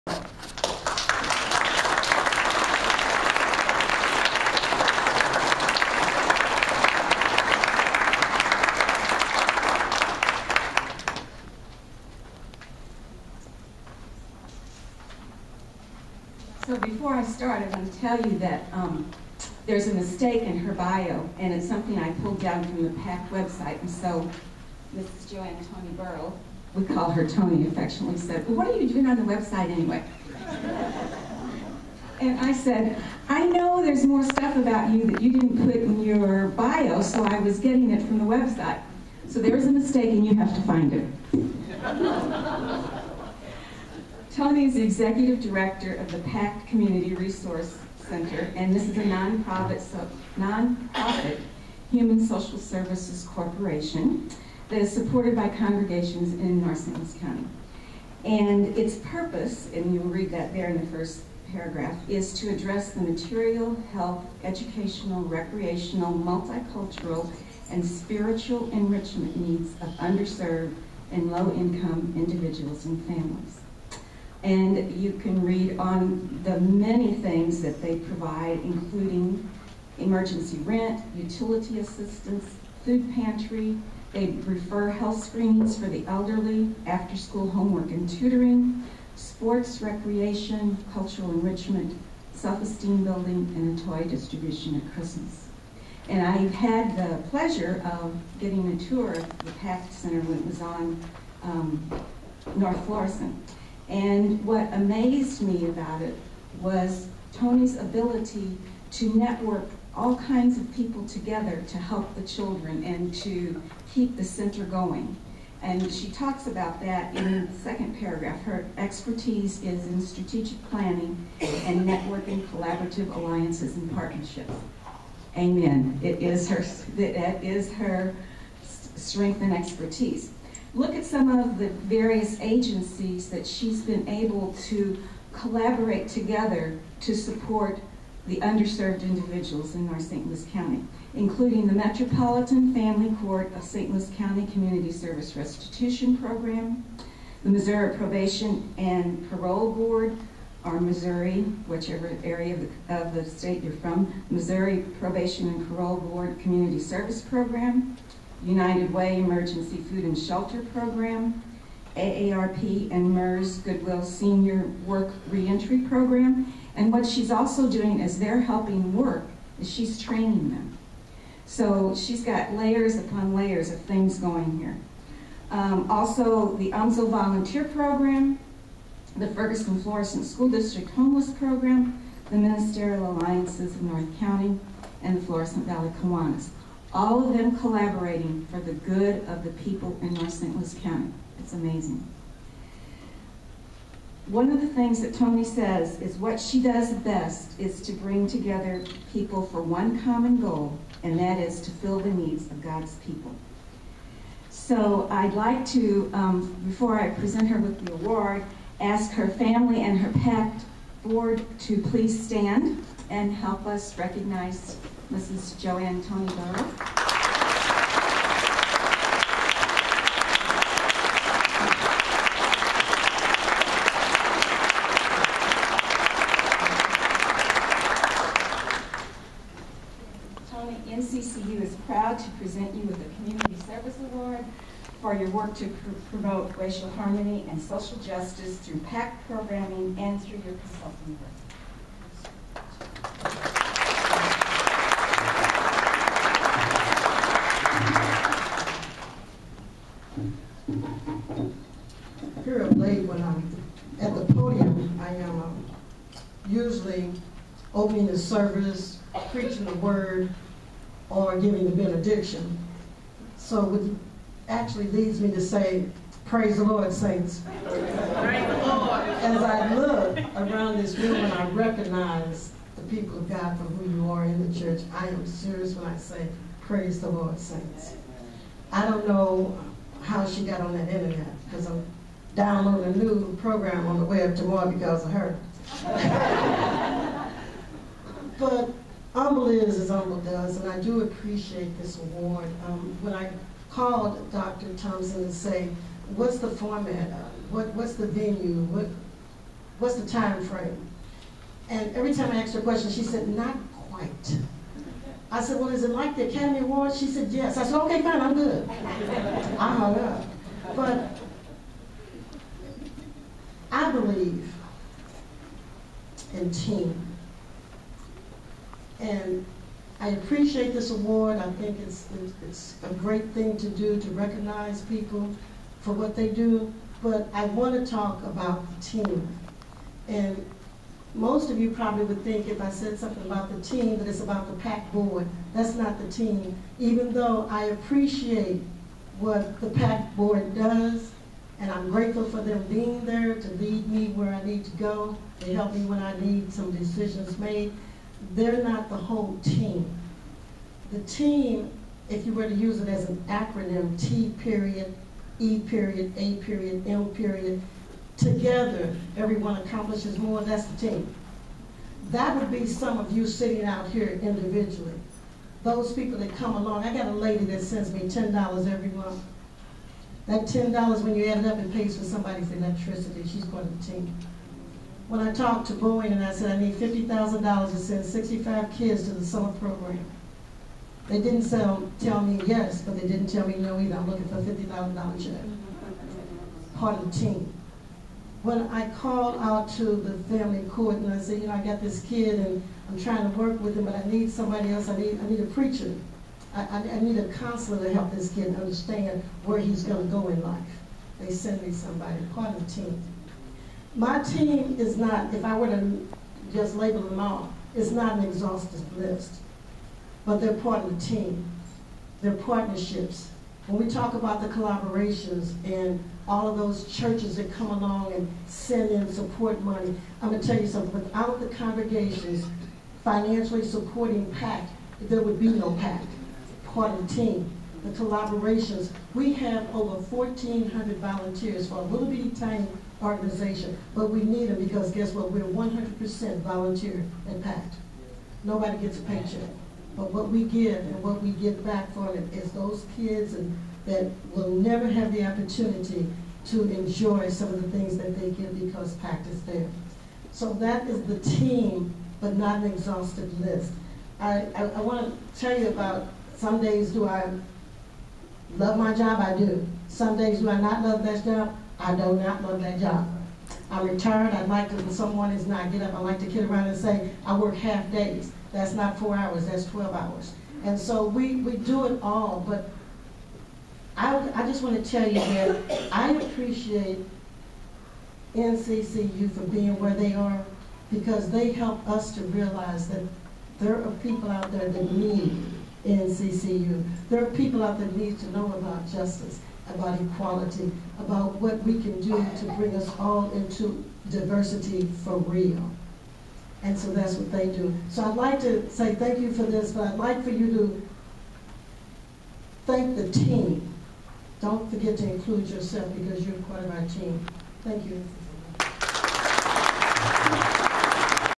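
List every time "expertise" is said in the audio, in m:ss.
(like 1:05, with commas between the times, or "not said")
1:58, 2:09.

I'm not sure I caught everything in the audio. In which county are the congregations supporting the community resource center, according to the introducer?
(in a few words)
Narcissus County.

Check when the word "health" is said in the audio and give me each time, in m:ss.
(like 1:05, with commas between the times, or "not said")
1:03, 1:24.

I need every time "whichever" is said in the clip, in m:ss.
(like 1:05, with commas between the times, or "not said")
2:31.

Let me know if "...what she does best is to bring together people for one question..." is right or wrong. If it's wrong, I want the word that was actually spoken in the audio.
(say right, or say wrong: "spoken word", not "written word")
wrong: "common", not "question".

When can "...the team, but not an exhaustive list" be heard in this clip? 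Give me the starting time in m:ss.
7:31.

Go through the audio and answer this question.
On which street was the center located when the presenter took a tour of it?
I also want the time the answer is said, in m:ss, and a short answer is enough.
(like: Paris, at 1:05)
North Florissant, at 1:42.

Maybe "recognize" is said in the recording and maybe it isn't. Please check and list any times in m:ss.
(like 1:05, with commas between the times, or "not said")
3:33, 4:31, 5:24.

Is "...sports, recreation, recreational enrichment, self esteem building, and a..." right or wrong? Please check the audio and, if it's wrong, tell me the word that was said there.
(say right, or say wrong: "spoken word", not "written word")
wrong: "cultural", not "recreational".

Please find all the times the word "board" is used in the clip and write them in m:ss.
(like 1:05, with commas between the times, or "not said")
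2:29, 2:35, 3:31, 5:34, 5:40.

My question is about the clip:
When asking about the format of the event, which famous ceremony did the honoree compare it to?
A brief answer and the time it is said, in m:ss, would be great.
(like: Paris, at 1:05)
Academy Awards, at 5:06.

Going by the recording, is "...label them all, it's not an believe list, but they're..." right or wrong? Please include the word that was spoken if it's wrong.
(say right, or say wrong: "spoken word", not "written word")
wrong: "exhaustive", not "believe".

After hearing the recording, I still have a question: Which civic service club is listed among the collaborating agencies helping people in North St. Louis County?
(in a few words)
Florissant Valley Kiwanis.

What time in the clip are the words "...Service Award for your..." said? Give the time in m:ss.
3:53.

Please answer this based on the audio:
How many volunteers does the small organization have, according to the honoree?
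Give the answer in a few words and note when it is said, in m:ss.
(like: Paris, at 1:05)
over 1,400, at 7:09.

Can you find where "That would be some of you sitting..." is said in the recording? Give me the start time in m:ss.
6:02.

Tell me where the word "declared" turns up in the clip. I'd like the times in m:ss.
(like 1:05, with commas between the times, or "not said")
not said.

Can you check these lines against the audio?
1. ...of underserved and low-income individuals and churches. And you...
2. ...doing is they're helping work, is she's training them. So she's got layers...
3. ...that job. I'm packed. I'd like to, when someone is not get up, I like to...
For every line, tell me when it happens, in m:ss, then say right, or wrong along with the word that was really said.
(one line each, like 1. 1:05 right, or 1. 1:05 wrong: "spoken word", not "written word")
1. 1:09 wrong: "families", not "churches"
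2. 2:47 right
3. 7:42 wrong: "retired", not "packed".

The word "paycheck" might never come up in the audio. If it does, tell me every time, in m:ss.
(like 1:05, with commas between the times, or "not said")
7:19.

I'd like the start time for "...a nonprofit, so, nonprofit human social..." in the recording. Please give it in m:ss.
0:48.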